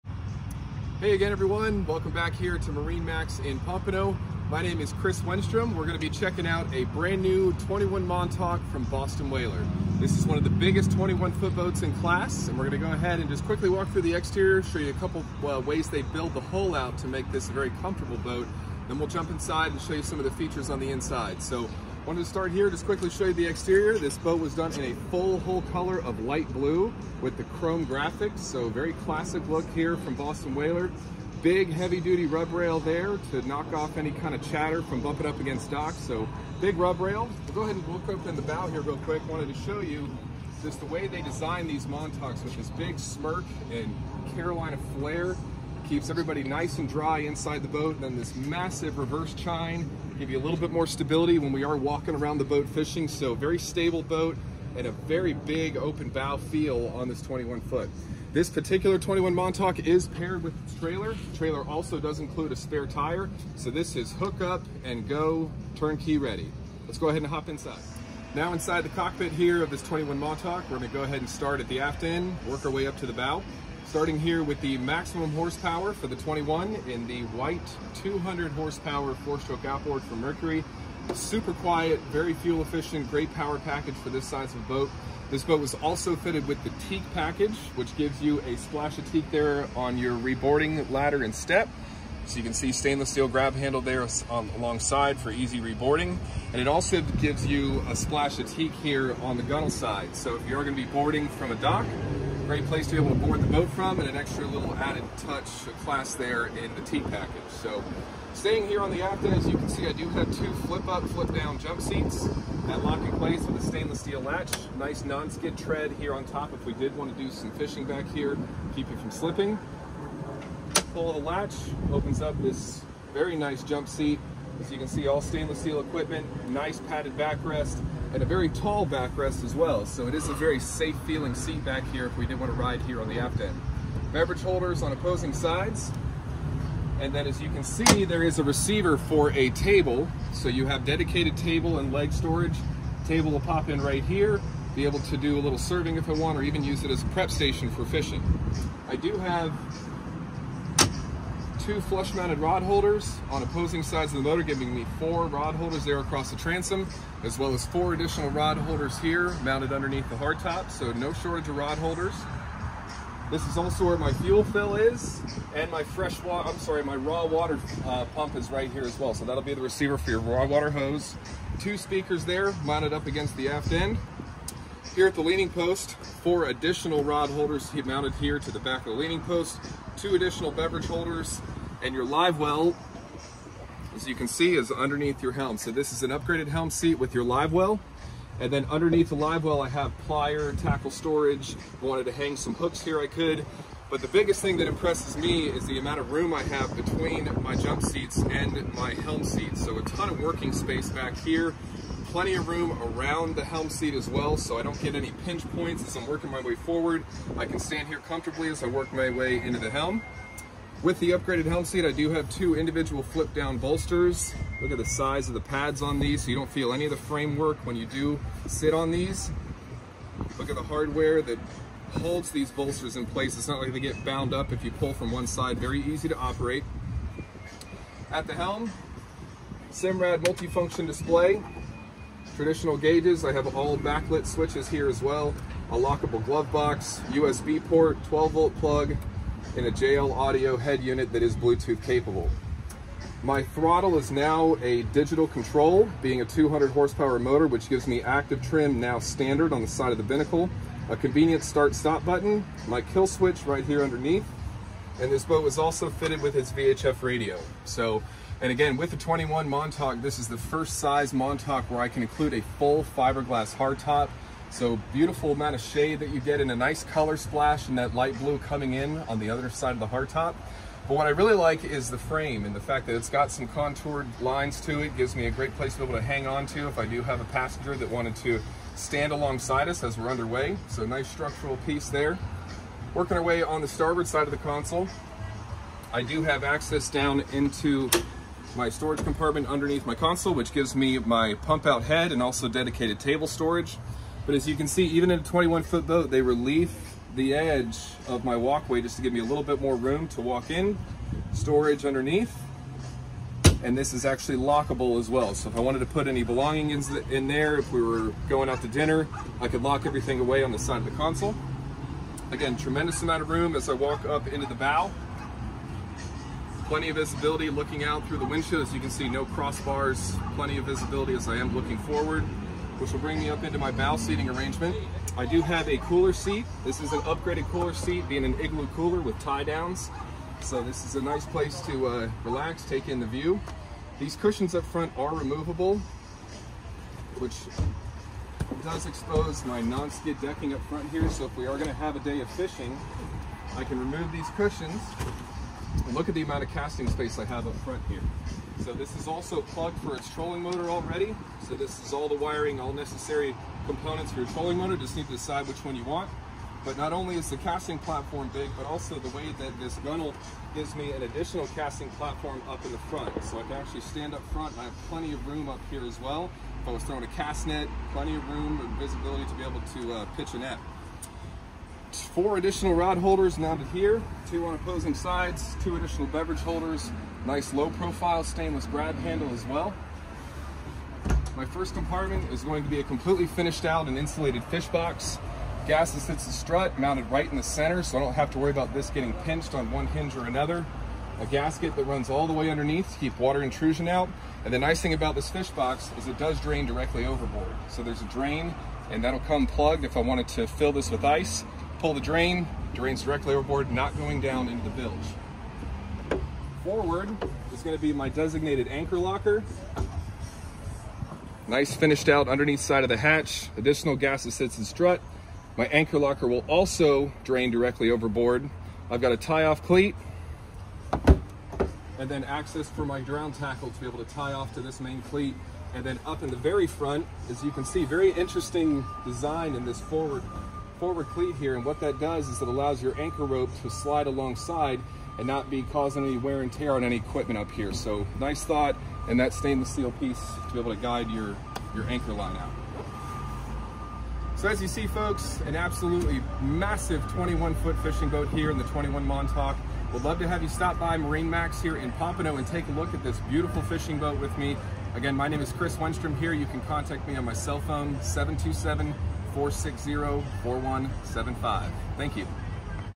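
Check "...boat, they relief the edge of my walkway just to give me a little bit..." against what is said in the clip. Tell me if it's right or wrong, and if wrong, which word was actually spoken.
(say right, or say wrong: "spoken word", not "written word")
right.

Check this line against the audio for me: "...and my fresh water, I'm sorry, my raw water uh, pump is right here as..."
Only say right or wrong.
right.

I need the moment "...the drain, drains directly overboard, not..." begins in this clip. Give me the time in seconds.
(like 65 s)
401 s.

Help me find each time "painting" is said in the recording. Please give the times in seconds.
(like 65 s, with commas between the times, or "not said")
not said.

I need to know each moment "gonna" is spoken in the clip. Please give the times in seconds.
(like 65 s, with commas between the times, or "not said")
5 s, 12 s, 70 s, 100 s, 341 s, 407 s.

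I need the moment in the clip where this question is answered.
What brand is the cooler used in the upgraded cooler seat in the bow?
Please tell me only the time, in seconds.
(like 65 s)
328 s.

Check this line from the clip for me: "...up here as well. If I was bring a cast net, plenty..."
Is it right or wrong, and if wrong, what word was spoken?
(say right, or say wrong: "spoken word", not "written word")
wrong: "throwing", not "bring".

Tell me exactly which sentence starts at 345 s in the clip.
And look at the amount of casting space I have up front here.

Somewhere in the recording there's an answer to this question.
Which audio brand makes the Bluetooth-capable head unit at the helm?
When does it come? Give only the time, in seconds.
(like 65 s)
239 s.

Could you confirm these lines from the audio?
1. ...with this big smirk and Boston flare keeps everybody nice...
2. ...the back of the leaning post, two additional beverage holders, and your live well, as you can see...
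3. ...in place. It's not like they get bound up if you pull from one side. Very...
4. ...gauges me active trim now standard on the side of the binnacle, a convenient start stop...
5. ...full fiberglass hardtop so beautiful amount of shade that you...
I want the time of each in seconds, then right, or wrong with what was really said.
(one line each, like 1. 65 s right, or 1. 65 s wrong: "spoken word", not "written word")
1. 42 s wrong: "Carolina", not "Boston"
2. 178 s right
3. 222 s right
4. 247 s wrong: "gives", not "gauges"
5. 262 s right.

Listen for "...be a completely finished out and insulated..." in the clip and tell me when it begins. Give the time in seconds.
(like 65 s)
382 s.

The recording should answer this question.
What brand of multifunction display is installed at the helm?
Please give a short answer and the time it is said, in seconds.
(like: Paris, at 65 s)
Simrad, at 229 s.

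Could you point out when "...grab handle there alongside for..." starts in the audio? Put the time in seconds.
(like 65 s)
93 s.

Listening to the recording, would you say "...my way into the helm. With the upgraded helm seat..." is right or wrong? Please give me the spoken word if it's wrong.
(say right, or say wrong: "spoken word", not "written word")
right.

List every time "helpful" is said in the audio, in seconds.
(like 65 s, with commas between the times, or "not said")
not said.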